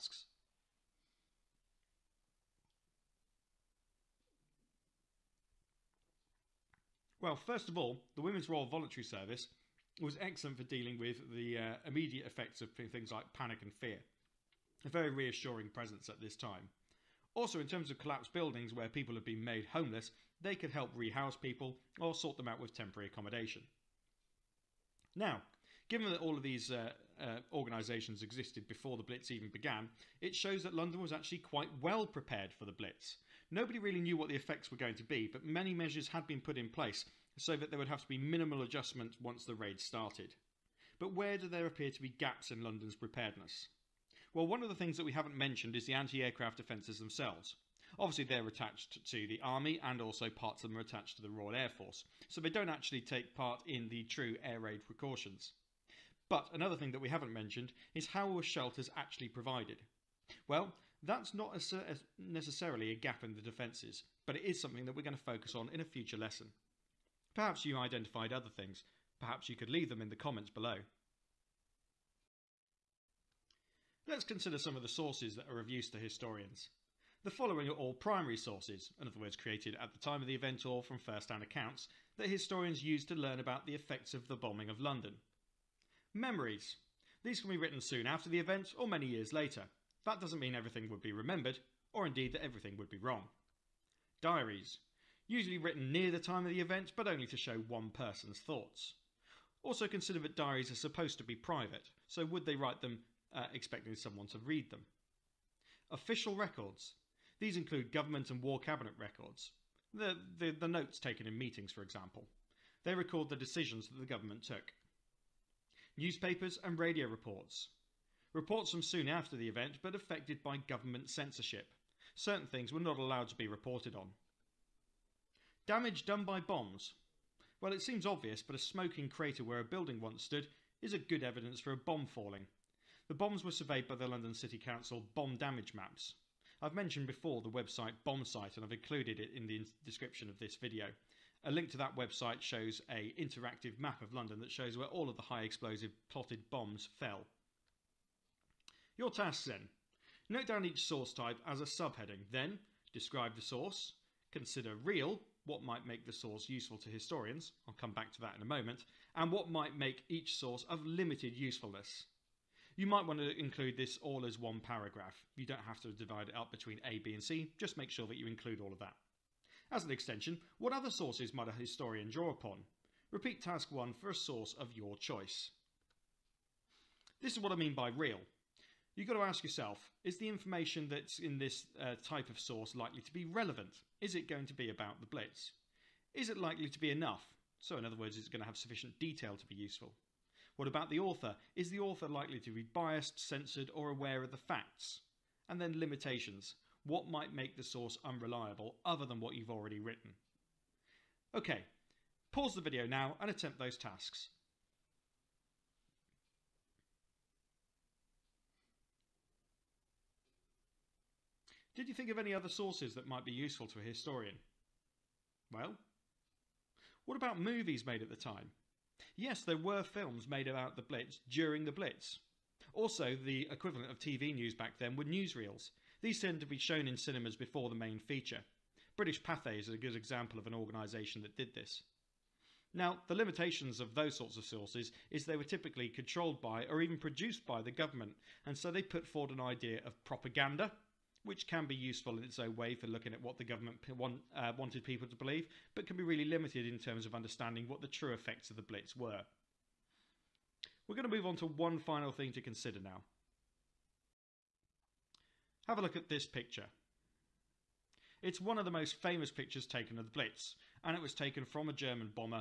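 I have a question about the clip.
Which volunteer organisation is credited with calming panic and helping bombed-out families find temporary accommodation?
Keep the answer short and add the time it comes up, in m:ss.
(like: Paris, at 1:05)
Women's Royal Voluntary Service, at 0:08.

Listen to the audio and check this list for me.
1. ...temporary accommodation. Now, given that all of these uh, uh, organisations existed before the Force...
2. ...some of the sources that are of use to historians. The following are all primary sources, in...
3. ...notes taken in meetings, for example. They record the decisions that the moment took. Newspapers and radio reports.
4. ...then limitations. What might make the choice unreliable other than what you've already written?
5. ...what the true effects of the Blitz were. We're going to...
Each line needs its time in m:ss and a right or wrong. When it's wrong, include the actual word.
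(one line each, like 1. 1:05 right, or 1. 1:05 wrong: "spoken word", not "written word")
1. 0:22 wrong: "Blitz", not "Force"
2. 1:14 right
3. 1:50 wrong: "government", not "moment"
4. 3:15 wrong: "source", not "choice"
5. 4:07 right.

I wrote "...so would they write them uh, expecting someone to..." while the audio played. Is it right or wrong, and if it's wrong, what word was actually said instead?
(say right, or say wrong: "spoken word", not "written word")
right.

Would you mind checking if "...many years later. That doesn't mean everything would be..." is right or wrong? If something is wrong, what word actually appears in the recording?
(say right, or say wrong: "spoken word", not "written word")
right.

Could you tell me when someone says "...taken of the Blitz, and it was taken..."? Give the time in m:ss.
4:19.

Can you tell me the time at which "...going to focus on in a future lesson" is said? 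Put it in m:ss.
1:05.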